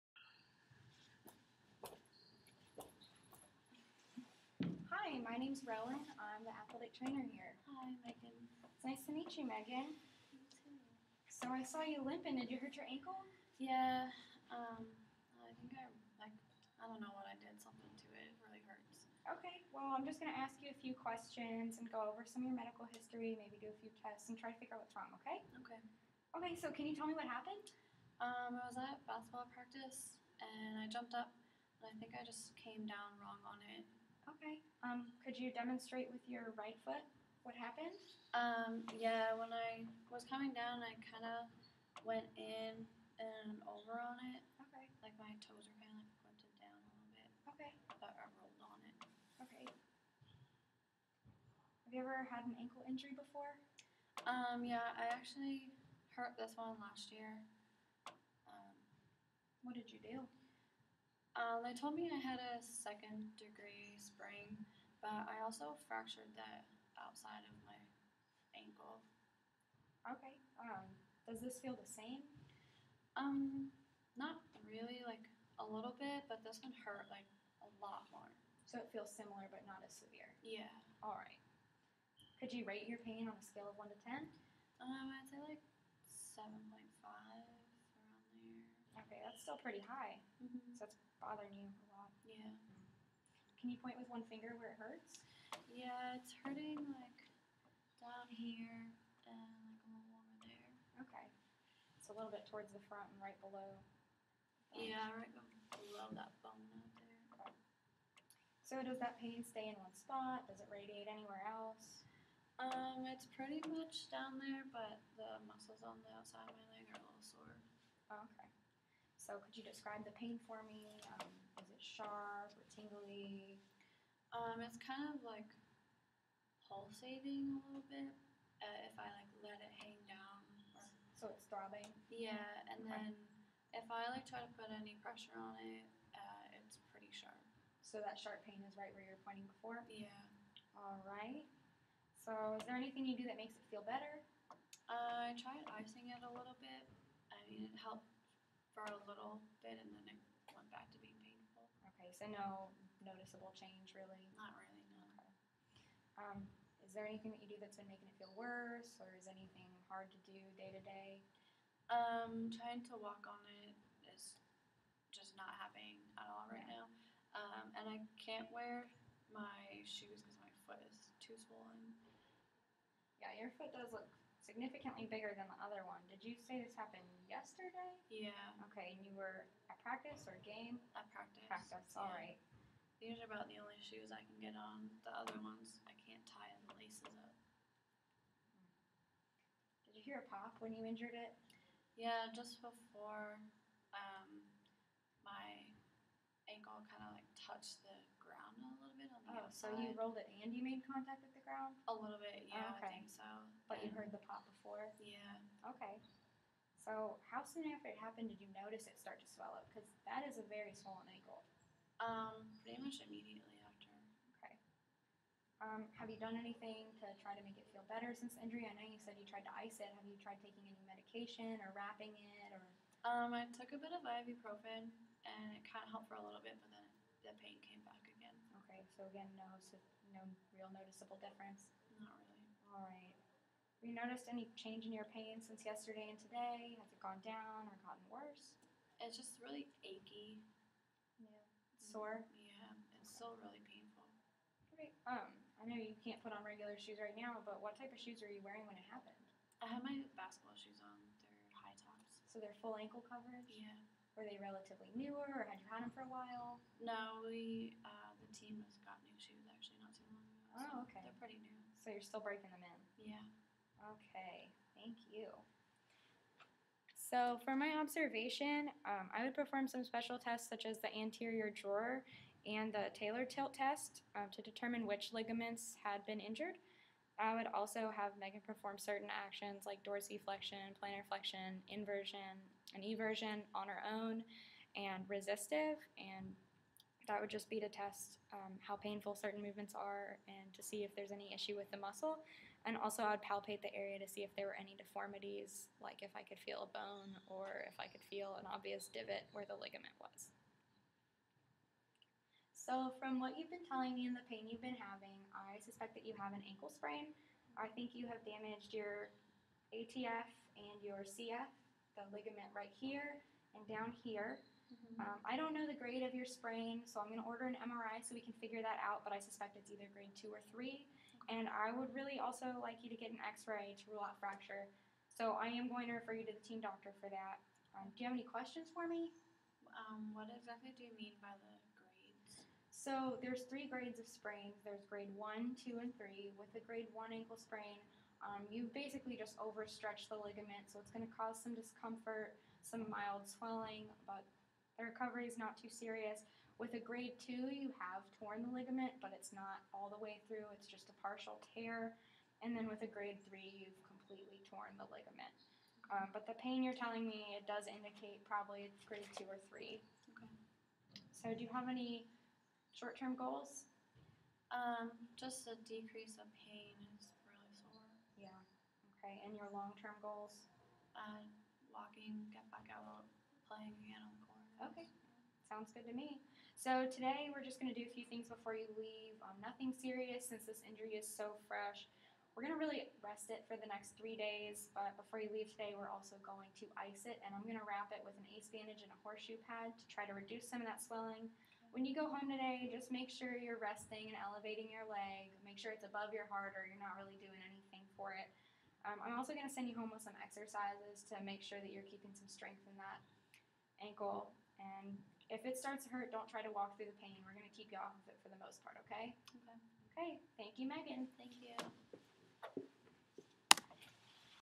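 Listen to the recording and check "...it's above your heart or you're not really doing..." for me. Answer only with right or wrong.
right.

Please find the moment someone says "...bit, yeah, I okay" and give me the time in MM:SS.
03:22.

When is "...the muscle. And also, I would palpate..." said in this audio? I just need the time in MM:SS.
04:51.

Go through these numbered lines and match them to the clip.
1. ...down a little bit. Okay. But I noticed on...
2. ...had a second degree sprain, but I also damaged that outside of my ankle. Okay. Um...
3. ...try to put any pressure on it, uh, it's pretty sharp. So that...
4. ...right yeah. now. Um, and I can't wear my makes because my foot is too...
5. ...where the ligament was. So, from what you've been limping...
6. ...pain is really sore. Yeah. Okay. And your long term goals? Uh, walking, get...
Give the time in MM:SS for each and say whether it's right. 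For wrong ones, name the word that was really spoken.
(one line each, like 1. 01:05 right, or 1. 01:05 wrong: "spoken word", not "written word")
1. 00:46 wrong: "rolled", not "noticed"
2. 01:02 wrong: "fractured", not "damaged"
3. 02:14 right
4. 02:46 wrong: "shoes", not "makes"
5. 04:59 wrong: "telling", not "limping"
6. 06:06 right.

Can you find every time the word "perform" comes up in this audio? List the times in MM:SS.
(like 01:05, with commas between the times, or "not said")
04:29, 04:38.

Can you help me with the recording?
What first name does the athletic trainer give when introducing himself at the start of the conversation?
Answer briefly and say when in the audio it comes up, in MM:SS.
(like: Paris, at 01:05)
Rowan, at 00:05.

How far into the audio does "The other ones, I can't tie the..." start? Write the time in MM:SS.
03:05.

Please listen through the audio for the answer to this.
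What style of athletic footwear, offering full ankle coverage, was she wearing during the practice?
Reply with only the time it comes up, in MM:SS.
04:11.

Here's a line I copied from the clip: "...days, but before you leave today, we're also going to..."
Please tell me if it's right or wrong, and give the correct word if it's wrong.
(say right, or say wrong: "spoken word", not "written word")
right.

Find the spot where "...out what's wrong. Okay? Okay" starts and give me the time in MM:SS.
00:24.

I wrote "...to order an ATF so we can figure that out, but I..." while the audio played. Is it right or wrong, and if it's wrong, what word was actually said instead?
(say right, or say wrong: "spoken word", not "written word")
wrong: "MRI", not "ATF".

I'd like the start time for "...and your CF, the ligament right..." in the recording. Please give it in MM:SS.
05:10.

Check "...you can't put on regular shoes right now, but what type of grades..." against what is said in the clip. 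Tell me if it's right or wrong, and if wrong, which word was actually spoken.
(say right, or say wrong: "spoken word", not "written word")
wrong: "shoes", not "grades".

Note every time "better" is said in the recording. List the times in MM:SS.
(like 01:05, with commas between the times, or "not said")
02:23, 03:37.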